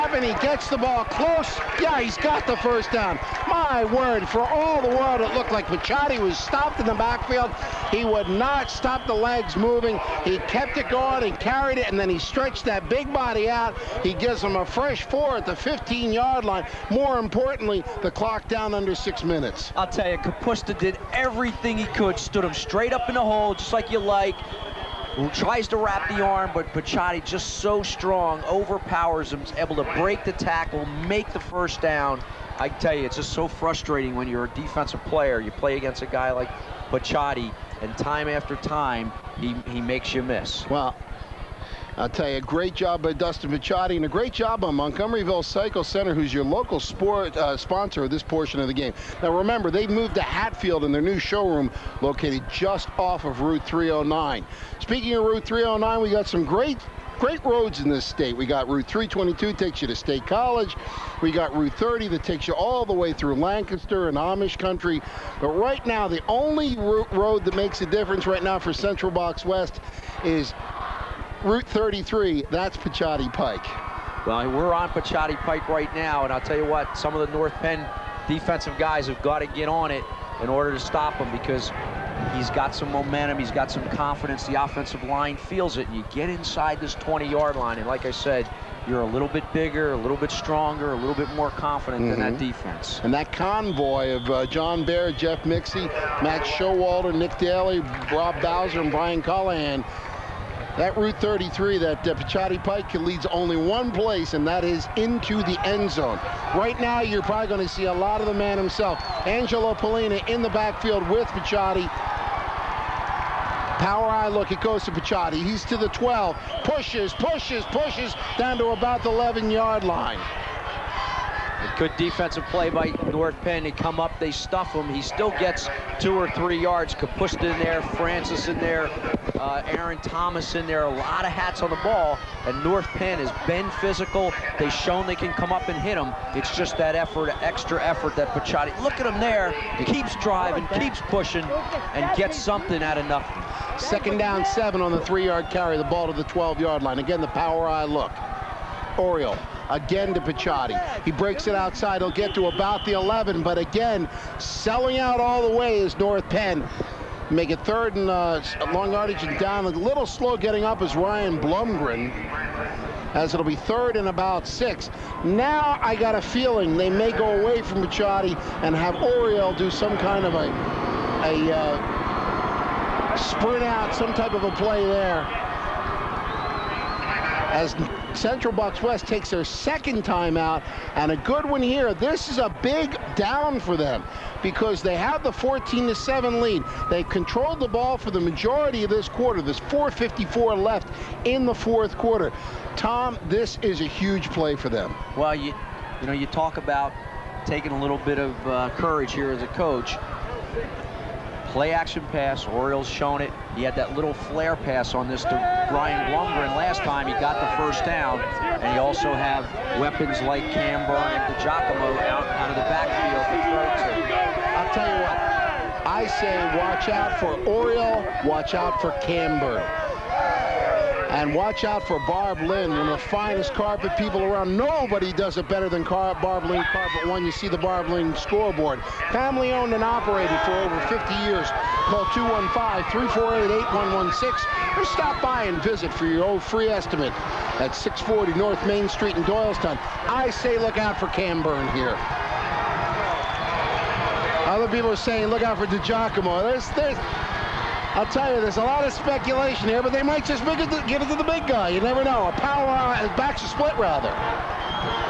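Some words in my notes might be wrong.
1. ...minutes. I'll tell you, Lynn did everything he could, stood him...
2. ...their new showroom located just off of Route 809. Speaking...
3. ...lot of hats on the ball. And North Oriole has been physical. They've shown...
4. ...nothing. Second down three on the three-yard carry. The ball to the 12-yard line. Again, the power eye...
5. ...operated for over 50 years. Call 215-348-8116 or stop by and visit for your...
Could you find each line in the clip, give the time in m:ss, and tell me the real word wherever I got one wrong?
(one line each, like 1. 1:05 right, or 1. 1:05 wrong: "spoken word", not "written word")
1. 0:19 wrong: "Kapusta", not "Lynn"
2. 0:50 wrong: "309", not "809"
3. 2:10 wrong: "Penn", not "Oriole"
4. 2:23 wrong: "seven", not "three"
5. 3:49 right.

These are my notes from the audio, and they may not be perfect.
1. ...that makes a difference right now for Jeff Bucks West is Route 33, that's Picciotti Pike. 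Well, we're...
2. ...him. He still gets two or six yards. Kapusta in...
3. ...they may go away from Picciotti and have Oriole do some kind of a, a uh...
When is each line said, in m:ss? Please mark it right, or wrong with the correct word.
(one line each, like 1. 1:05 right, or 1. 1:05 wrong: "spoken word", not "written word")
1. 1:07 wrong: "Central", not "Jeff"
2. 2:04 wrong: "three", not "six"
3. 2:46 right.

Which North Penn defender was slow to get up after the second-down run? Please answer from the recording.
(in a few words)
Ryan Blumgren.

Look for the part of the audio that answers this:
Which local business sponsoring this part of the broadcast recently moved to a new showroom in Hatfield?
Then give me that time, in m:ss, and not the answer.
0:44.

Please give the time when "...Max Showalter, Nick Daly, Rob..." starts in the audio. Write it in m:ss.
1:36.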